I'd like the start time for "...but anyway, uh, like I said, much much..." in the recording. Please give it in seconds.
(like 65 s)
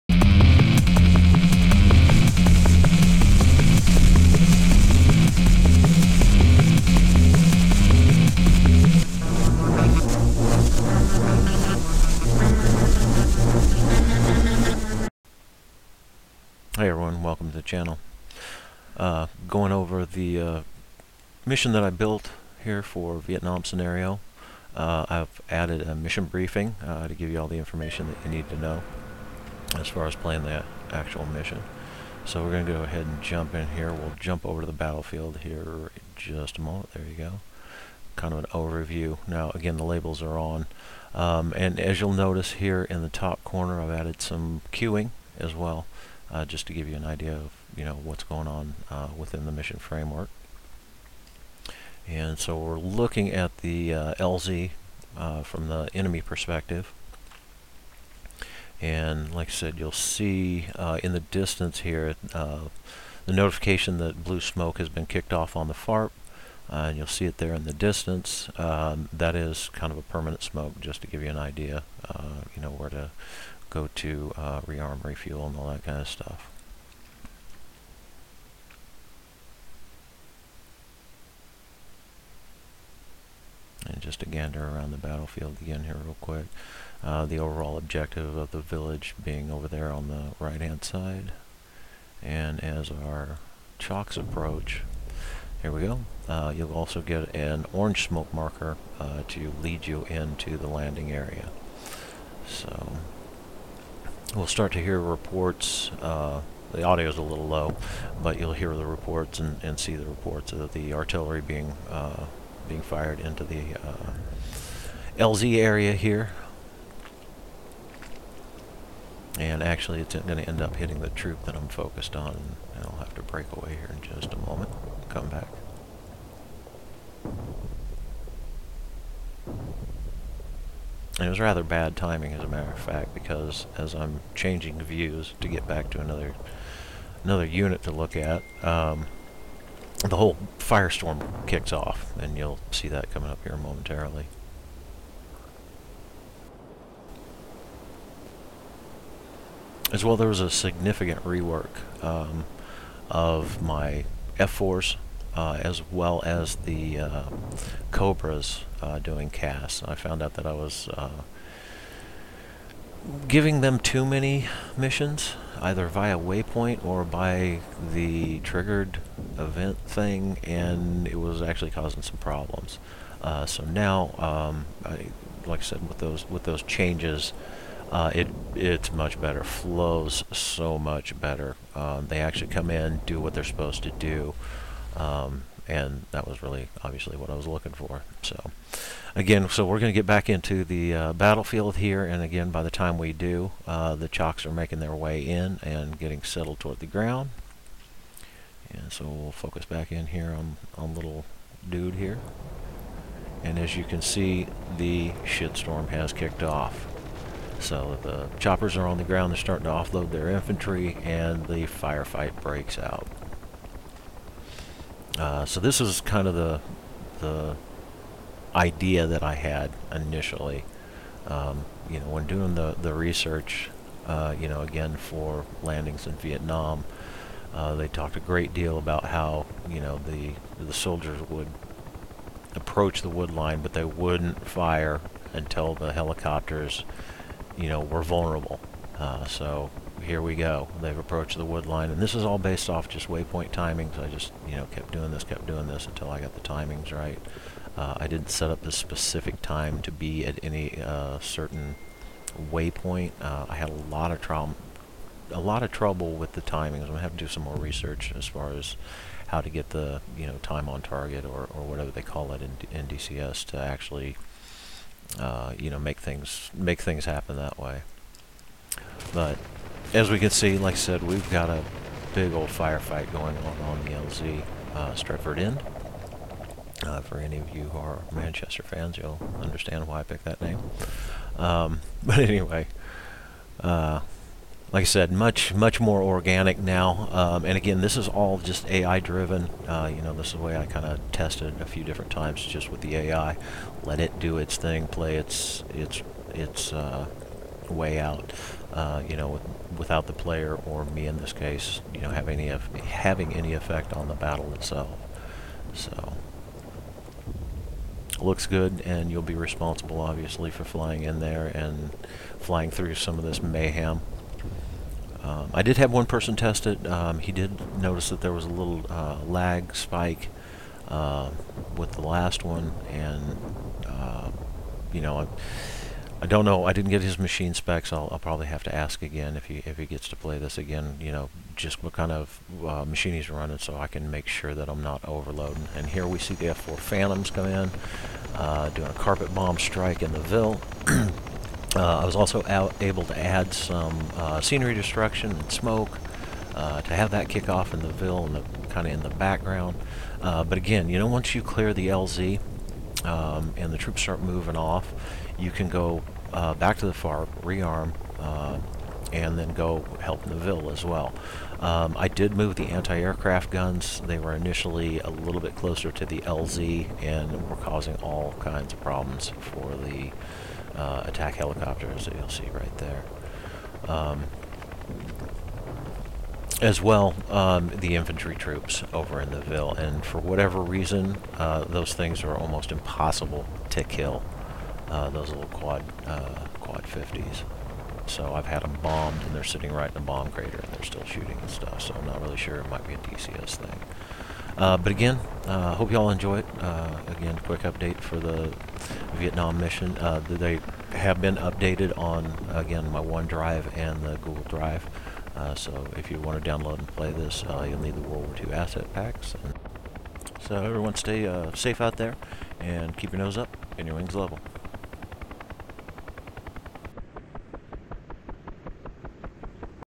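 282 s.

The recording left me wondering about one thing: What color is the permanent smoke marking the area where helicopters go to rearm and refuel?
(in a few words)
Blue.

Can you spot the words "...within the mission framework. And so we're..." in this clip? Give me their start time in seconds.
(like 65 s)
49 s.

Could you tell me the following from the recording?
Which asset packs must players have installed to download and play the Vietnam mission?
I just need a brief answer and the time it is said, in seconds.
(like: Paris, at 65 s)
World War II asset packs, at 408 s.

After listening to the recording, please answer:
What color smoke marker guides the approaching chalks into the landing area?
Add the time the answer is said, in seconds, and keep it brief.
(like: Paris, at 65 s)
Orange, at 97 s.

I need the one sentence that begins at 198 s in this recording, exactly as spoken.
And so we'll focus back in here on, on little dude here.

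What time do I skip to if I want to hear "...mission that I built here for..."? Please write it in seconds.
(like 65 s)
21 s.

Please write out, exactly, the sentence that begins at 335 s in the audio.
And here we see the F4 Phantoms come in, uh, doing a carpet bomb strike in the Ville.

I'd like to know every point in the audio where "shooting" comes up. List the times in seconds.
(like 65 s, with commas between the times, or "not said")
391 s.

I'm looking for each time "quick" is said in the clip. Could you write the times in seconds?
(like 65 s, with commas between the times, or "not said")
86 s, 397 s.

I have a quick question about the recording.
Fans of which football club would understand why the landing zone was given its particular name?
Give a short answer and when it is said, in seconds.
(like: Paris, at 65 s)
Manchester, at 278 s.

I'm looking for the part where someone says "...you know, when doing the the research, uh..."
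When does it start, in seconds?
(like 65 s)
221 s.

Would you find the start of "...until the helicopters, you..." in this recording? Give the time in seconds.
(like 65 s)
235 s.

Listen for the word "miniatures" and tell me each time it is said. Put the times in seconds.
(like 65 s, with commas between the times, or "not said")
not said.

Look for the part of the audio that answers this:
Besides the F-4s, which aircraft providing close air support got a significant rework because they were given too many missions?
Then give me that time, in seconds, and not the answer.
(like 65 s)
157 s.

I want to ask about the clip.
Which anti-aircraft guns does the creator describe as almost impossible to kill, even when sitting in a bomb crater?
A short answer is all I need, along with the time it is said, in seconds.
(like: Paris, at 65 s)
Quad 50s, at 386 s.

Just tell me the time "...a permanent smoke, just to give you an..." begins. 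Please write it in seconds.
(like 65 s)
69 s.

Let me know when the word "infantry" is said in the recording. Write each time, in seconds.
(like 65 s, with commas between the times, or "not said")
210 s, 377 s.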